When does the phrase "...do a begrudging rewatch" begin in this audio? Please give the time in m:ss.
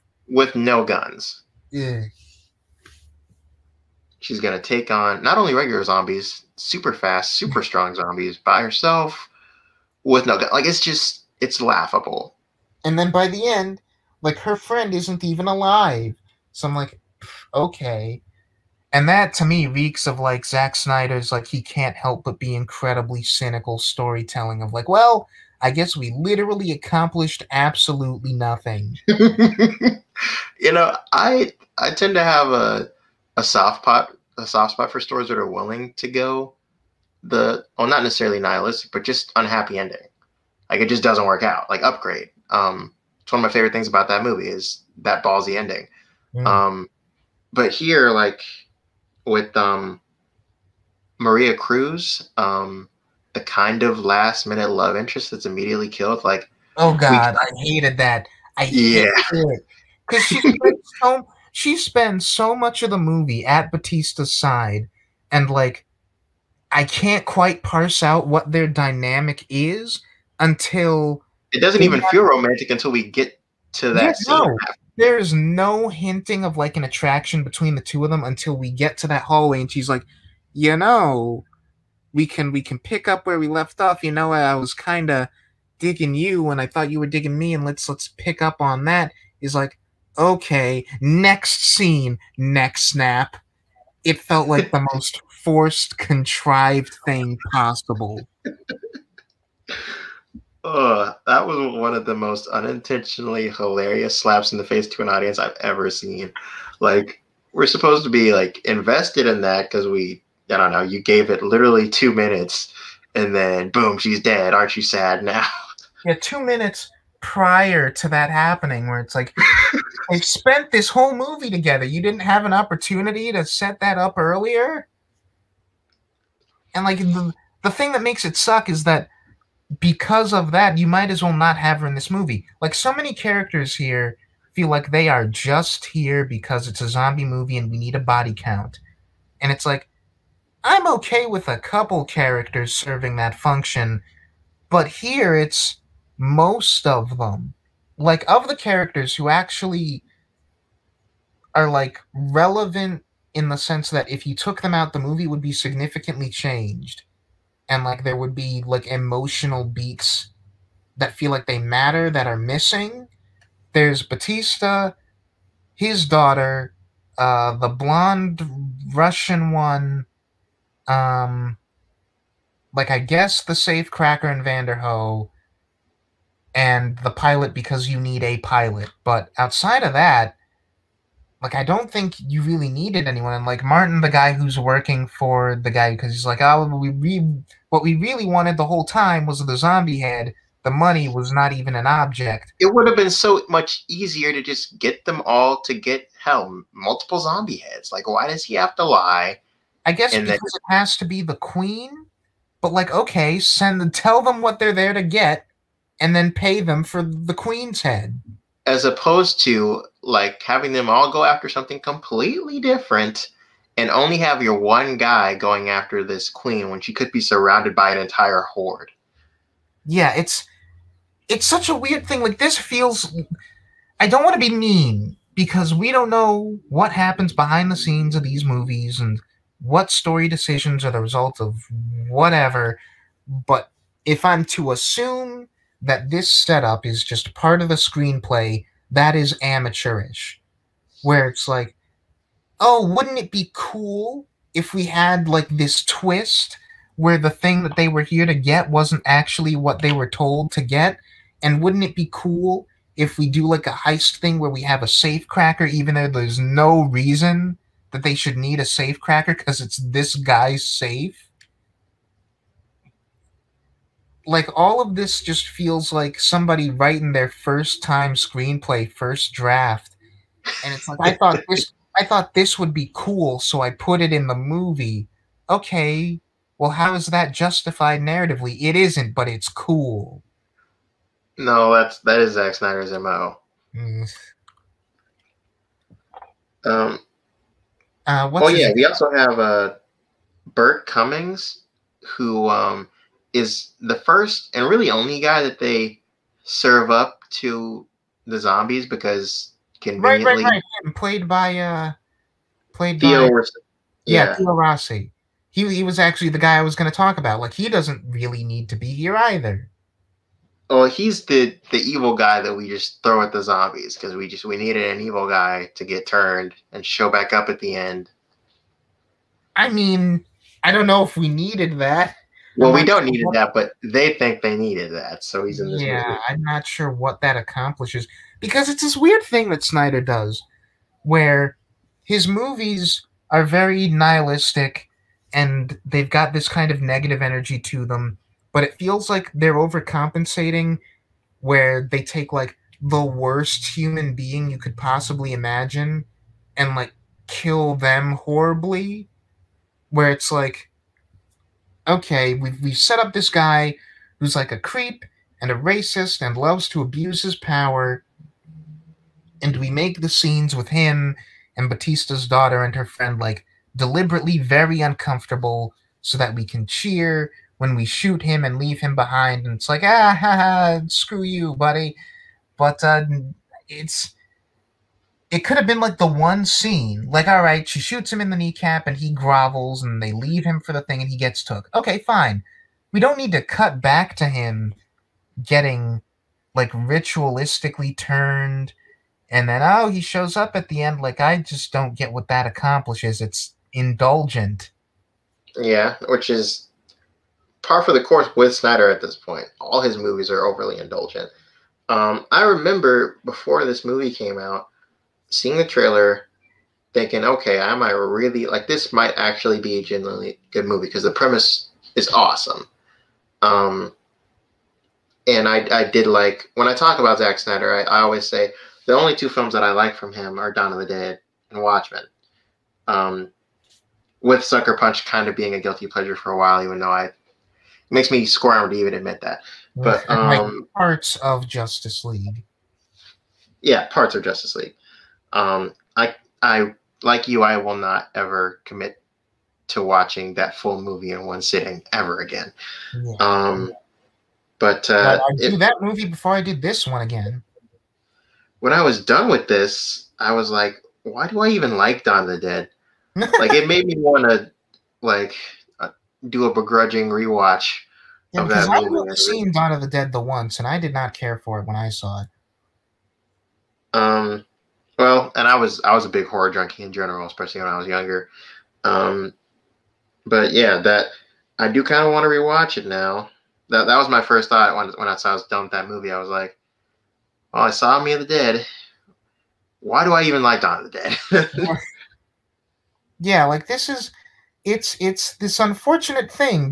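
7:36.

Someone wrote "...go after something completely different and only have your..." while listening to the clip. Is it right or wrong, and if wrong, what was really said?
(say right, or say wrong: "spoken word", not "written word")
right.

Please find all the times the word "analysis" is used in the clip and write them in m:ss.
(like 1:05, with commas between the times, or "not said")
not said.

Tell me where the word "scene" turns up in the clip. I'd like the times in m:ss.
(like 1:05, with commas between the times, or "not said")
1:31, 3:47, 6:00, 6:16.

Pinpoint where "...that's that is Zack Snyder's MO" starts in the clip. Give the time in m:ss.
4:41.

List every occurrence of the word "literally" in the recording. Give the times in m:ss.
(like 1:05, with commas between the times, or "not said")
0:26, 1:51.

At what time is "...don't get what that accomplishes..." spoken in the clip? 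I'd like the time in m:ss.
6:31.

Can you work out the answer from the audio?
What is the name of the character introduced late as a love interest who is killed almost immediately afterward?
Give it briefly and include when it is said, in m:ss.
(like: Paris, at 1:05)
Maria Cruz, at 0:51.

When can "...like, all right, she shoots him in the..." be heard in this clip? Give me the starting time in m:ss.
6:17.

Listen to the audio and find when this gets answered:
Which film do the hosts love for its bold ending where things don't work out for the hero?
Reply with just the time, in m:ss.
0:41.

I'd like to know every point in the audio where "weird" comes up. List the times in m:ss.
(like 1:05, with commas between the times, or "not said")
3:41, 5:28.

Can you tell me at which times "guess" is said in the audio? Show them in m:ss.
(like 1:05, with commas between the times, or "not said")
0:25, 2:52, 3:19.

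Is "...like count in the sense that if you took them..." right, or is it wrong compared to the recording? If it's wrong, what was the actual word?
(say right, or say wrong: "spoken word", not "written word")
wrong: "relevant", not "count".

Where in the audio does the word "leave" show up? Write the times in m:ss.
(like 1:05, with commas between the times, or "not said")
6:08, 6:20.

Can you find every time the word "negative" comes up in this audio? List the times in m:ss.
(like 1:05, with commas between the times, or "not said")
5:36.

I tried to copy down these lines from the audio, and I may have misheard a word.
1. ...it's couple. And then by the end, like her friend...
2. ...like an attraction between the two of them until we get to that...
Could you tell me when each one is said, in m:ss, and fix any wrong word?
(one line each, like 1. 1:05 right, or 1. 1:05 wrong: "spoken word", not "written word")
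1. 0:11 wrong: "laughable", not "couple"
2. 1:16 right.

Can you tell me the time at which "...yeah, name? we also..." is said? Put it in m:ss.
4:48.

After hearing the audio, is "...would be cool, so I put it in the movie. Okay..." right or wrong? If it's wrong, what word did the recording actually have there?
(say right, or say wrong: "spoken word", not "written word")
right.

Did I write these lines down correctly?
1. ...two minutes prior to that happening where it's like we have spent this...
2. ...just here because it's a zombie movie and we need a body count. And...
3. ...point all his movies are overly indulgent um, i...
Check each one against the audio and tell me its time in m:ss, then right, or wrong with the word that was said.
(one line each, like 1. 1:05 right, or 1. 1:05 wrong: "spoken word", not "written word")
1. 1:56 right
2. 2:15 right
3. 6:39 right.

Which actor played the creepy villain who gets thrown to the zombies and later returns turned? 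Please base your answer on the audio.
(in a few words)
Theo Rossi.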